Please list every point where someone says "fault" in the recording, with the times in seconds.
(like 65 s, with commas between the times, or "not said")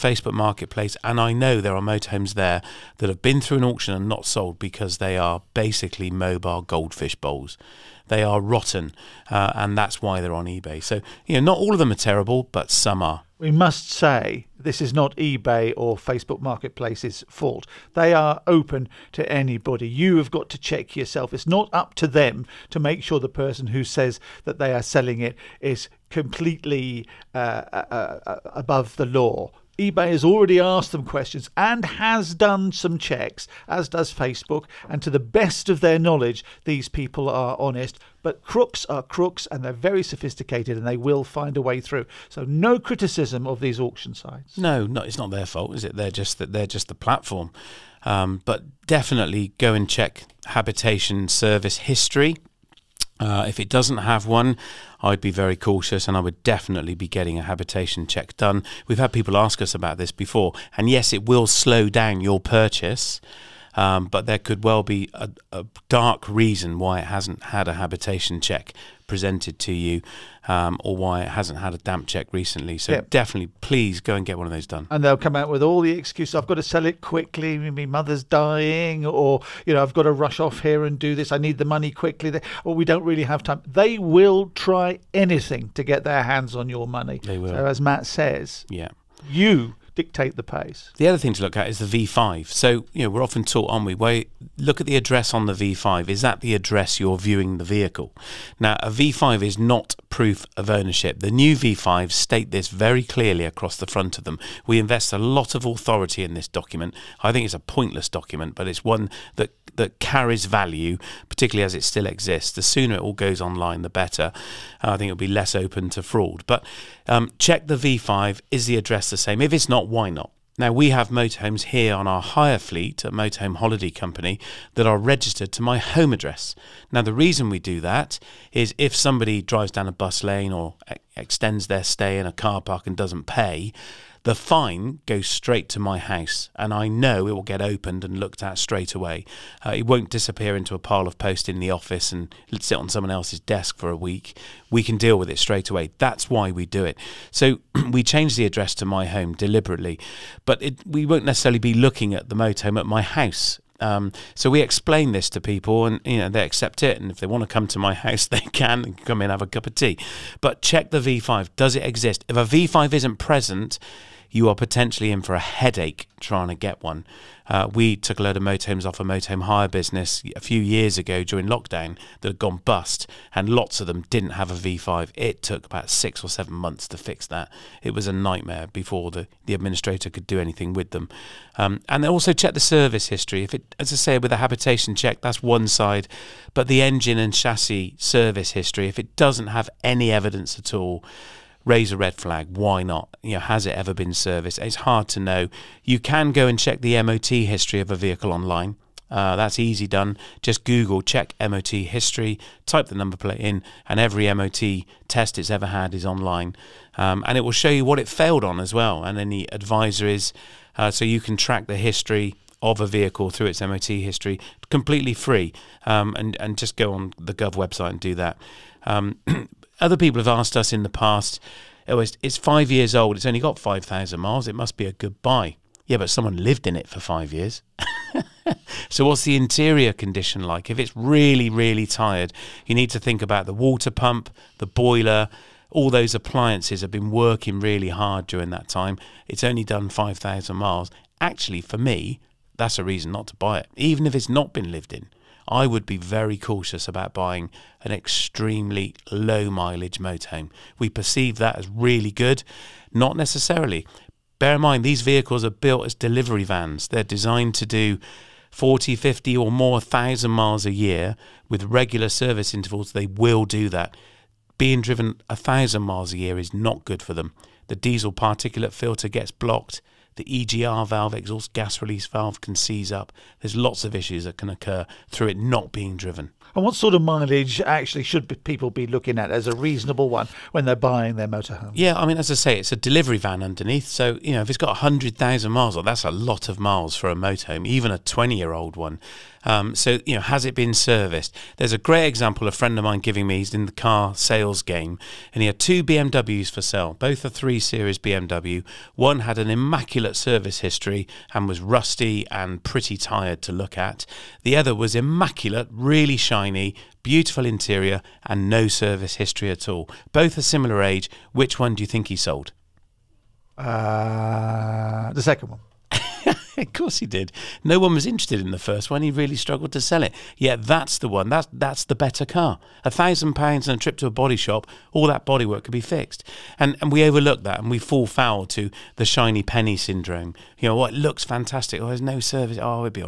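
17 s, 45 s.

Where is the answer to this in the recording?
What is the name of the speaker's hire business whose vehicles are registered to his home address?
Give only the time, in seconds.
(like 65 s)
123 s.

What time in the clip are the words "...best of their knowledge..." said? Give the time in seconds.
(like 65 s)
35 s.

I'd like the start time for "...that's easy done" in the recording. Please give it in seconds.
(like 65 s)
199 s.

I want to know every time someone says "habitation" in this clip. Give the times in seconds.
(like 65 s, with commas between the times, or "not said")
50 s, 57 s, 67 s, 184 s.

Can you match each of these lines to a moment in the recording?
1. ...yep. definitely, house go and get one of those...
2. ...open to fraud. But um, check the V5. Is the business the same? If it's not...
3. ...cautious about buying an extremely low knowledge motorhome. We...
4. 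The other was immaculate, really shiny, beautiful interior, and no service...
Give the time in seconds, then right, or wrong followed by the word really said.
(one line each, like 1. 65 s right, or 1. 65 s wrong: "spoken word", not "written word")
1. 72 s wrong: "please", not "house"
2. 115 s wrong: "address", not "business"
3. 246 s wrong: "mileage", not "knowledge"
4. 304 s right.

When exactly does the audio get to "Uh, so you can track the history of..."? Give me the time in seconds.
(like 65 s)
210 s.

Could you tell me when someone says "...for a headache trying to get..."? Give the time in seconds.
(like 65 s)
165 s.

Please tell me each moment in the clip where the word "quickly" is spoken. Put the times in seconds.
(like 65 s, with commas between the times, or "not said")
77 s, 81 s.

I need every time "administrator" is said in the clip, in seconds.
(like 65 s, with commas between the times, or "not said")
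179 s.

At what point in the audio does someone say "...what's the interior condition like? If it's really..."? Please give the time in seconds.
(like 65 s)
229 s.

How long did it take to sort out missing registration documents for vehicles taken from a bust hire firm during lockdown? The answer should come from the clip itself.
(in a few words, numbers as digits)
six or seven months.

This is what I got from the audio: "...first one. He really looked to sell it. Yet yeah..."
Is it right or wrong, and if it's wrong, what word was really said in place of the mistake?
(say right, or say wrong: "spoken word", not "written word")
wrong: "struggled", not "looked".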